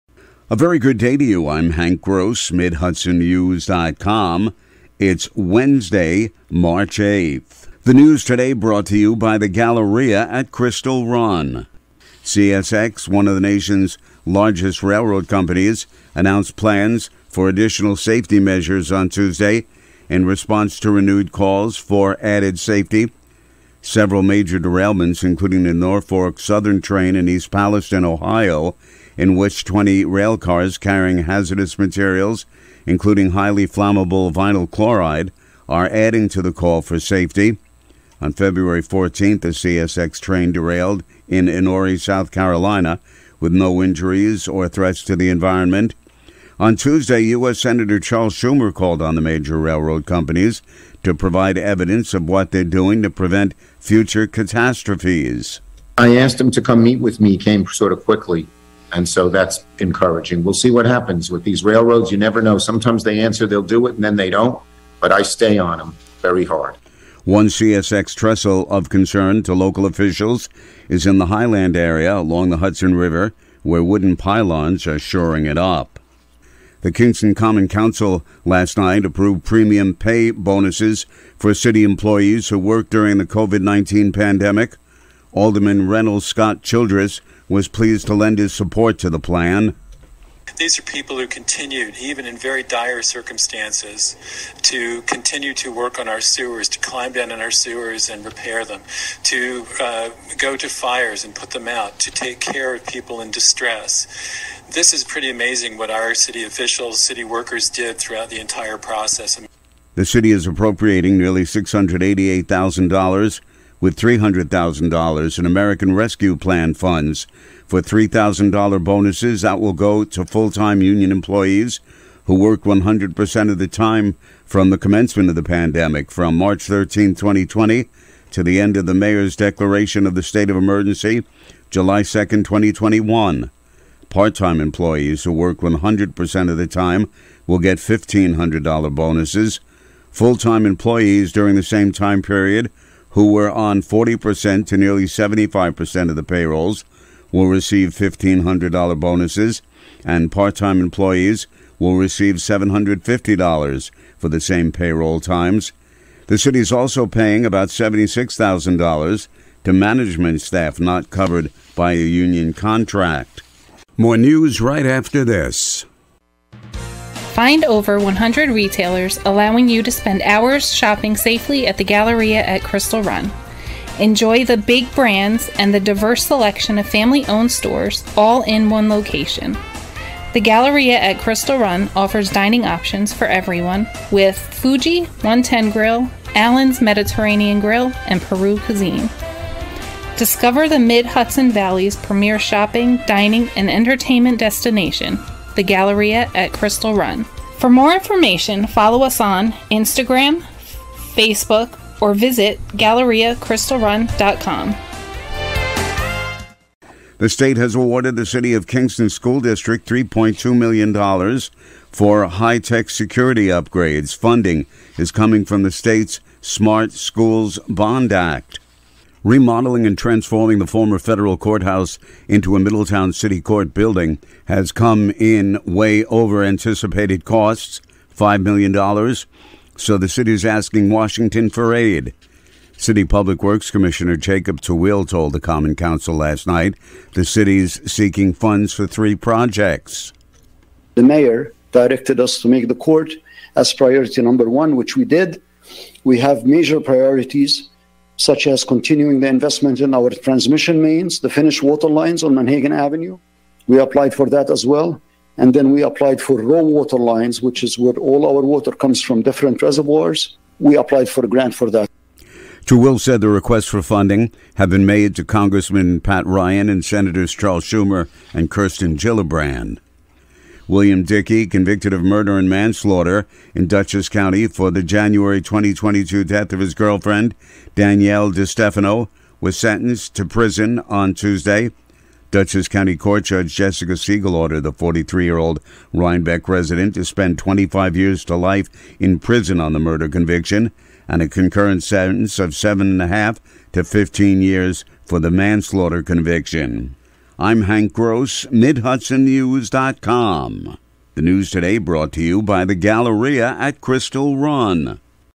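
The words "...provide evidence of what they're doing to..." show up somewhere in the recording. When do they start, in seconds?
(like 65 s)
51 s.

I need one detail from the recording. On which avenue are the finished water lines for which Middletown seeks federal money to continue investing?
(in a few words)
Monhagen Avenue.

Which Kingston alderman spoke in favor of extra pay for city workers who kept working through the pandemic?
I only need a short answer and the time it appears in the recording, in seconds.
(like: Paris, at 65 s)
Reynolds Scott Childress, at 85 s.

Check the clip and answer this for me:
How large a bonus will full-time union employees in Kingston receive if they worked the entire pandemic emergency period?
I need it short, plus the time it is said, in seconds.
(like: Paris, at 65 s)
$3,000, at 117 s.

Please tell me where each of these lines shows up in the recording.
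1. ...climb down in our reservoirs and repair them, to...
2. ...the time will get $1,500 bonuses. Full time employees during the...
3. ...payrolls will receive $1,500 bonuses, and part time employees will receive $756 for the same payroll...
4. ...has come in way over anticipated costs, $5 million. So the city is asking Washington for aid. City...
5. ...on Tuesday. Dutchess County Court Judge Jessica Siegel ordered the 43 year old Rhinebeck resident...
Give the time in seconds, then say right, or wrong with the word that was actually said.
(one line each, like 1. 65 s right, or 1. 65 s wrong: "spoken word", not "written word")
1. 96 s wrong: "sewers", not "reservoirs"
2. 136 s right
3. 146 s wrong: "750", not "756"
4. 224 s right
5. 280 s right.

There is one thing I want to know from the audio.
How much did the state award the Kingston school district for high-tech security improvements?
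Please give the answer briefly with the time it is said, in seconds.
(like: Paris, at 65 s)
$3.2 million, at 209 s.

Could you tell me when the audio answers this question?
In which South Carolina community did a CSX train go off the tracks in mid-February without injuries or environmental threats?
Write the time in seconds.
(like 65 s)
41 s.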